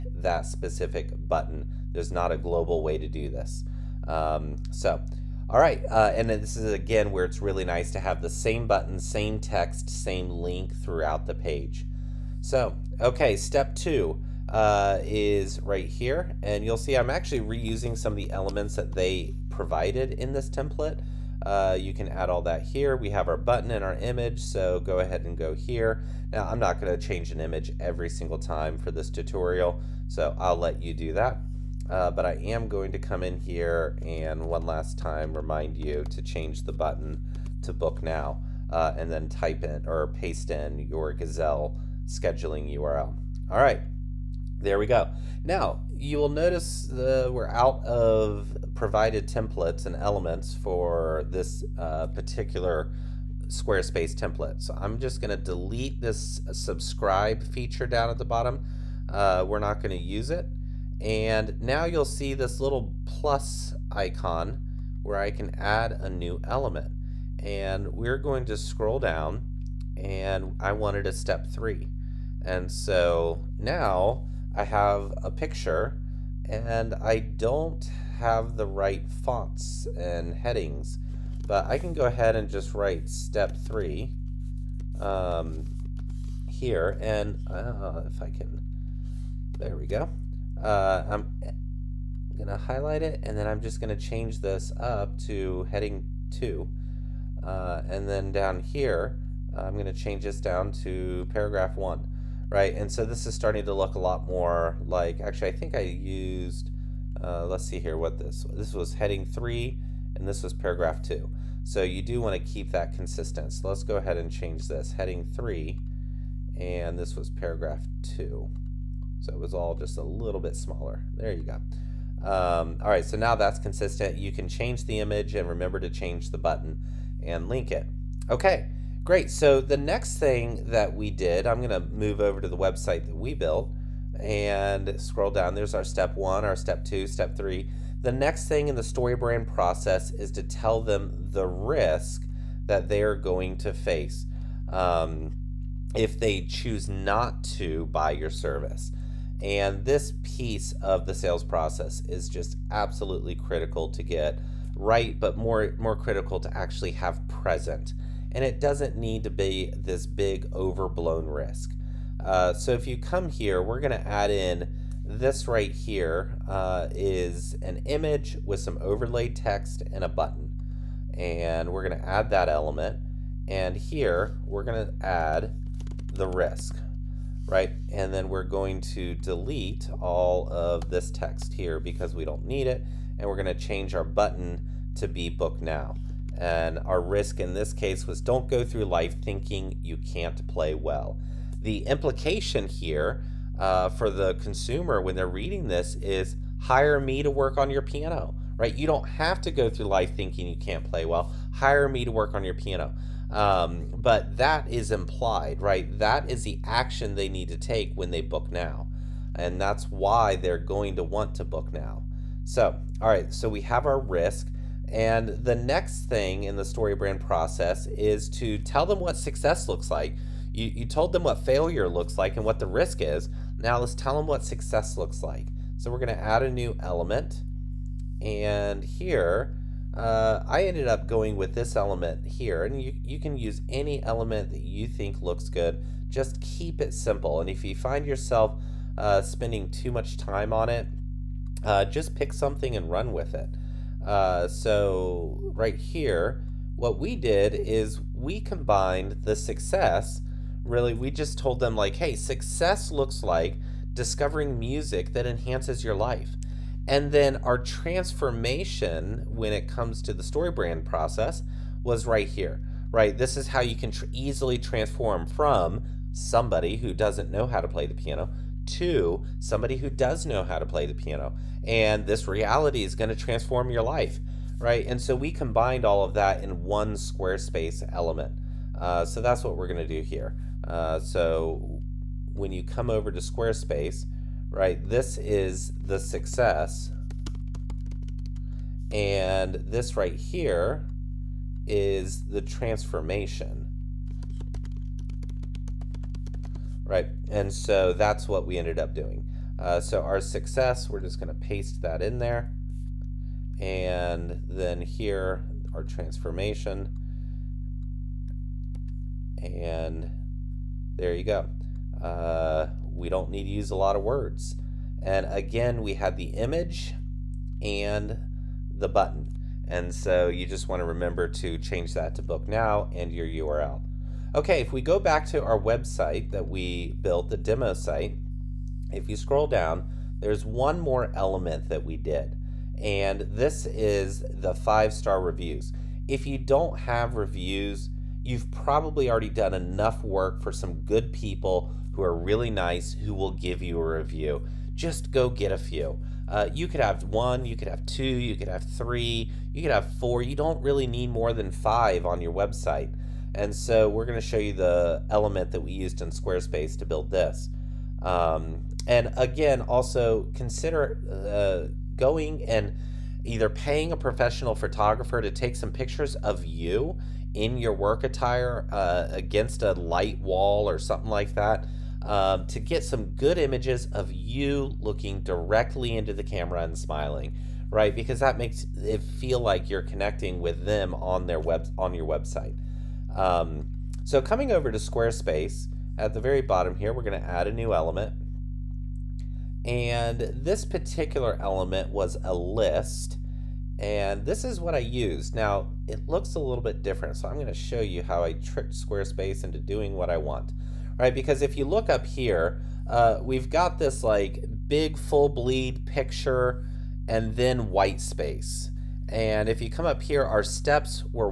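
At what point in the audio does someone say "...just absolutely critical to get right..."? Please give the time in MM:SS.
02:32.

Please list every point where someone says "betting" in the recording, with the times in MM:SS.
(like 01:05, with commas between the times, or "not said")
not said.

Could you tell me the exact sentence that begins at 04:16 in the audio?
And then our transformation when it comes to the StoryBrand process was right here, right?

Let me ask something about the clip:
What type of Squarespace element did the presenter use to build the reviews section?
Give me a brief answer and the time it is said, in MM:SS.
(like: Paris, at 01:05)
a list, at 06:32.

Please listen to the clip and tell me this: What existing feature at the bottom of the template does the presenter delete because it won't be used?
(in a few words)
subscribe feature.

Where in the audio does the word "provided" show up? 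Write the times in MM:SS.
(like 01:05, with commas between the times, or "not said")
00:19, 00:48.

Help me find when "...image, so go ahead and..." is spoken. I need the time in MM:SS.
00:23.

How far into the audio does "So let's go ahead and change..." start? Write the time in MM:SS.
01:53.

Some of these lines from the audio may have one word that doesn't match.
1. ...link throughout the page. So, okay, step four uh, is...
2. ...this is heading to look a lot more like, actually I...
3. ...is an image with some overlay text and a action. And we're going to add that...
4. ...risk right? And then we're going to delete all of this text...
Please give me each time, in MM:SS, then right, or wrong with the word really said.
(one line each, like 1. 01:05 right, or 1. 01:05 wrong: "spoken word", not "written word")
1. 00:10 wrong: "two", not "four"
2. 01:43 wrong: "starting", not "heading"
3. 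02:46 wrong: "button", not "action"
4. 02:56 right.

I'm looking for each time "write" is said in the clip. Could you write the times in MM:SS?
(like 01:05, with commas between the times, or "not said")
01:22.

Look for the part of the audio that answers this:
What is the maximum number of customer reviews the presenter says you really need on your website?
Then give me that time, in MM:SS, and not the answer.
05:51.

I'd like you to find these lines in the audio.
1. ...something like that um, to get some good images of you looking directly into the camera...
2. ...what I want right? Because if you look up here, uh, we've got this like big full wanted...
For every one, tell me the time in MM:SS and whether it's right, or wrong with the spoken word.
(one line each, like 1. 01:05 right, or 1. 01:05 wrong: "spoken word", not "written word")
1. 06:10 right
2. 06:39 wrong: "bleed", not "wanted".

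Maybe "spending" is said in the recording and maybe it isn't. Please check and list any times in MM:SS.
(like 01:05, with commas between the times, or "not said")
03:59.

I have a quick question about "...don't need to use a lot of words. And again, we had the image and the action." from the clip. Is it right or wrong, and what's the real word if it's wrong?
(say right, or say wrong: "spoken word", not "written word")
wrong: "button", not "action".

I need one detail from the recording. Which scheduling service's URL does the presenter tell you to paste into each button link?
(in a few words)
Gazelle.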